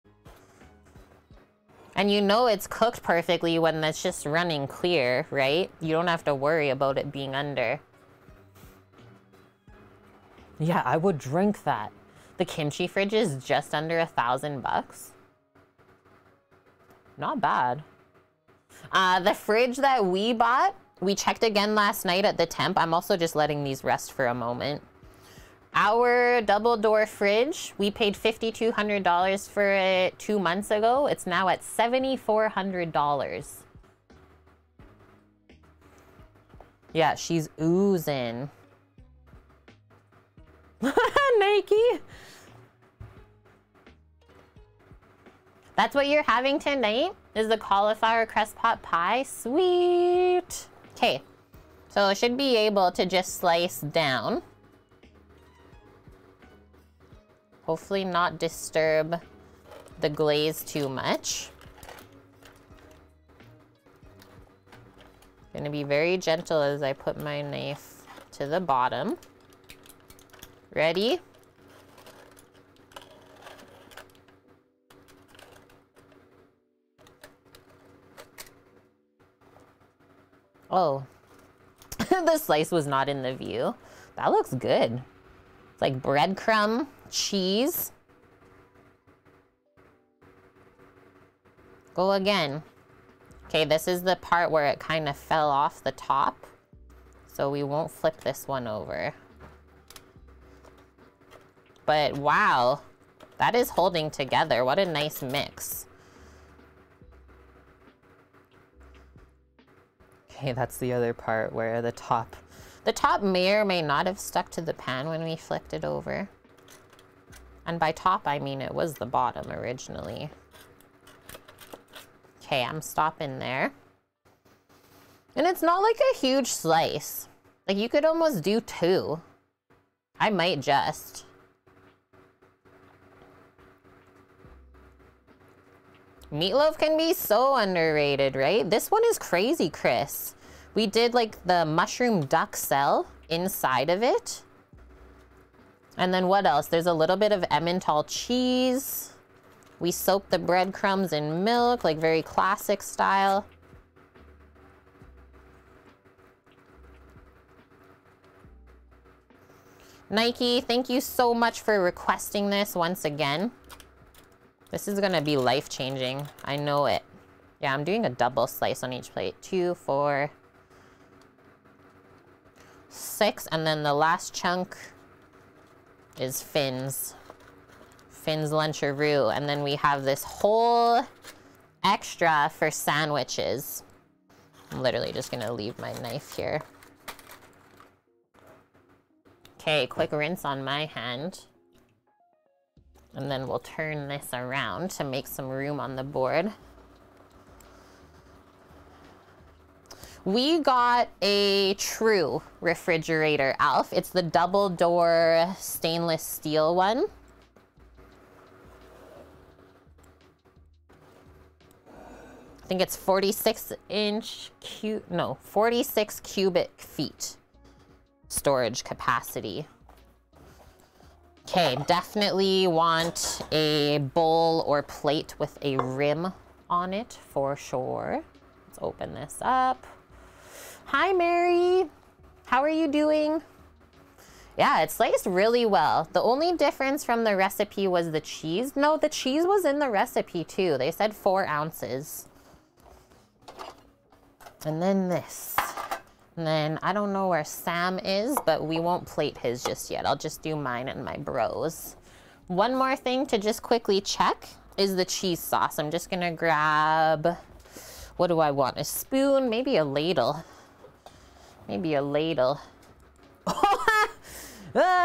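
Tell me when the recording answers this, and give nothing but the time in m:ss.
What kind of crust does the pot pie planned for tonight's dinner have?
0:47.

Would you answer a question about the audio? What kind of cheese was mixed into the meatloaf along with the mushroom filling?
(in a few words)
Emmental.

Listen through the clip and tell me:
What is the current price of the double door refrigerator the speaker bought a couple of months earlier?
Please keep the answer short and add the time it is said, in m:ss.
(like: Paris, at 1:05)
$7,400, at 0:31.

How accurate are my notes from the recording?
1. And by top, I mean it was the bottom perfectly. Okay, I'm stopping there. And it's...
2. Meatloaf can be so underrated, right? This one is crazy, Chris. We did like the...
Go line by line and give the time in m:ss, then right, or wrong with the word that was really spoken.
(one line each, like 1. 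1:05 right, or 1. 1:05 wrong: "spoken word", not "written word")
1. 1:57 wrong: "originally", not "perfectly"
2. 2:16 right.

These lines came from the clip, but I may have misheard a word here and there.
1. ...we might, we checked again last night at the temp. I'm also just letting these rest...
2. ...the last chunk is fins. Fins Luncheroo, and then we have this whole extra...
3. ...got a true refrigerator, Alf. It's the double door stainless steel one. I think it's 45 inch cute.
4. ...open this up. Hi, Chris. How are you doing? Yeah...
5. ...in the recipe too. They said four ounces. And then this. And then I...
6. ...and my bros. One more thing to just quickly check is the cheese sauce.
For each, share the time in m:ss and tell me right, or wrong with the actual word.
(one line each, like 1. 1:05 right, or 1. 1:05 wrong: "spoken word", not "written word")
1. 0:20 wrong: "bought", not "might"
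2. 2:53 right
3. 3:20 wrong: "46", not "45"
4. 3:48 wrong: "Mary", not "Chris"
5. 3:59 right
6. 4:10 right.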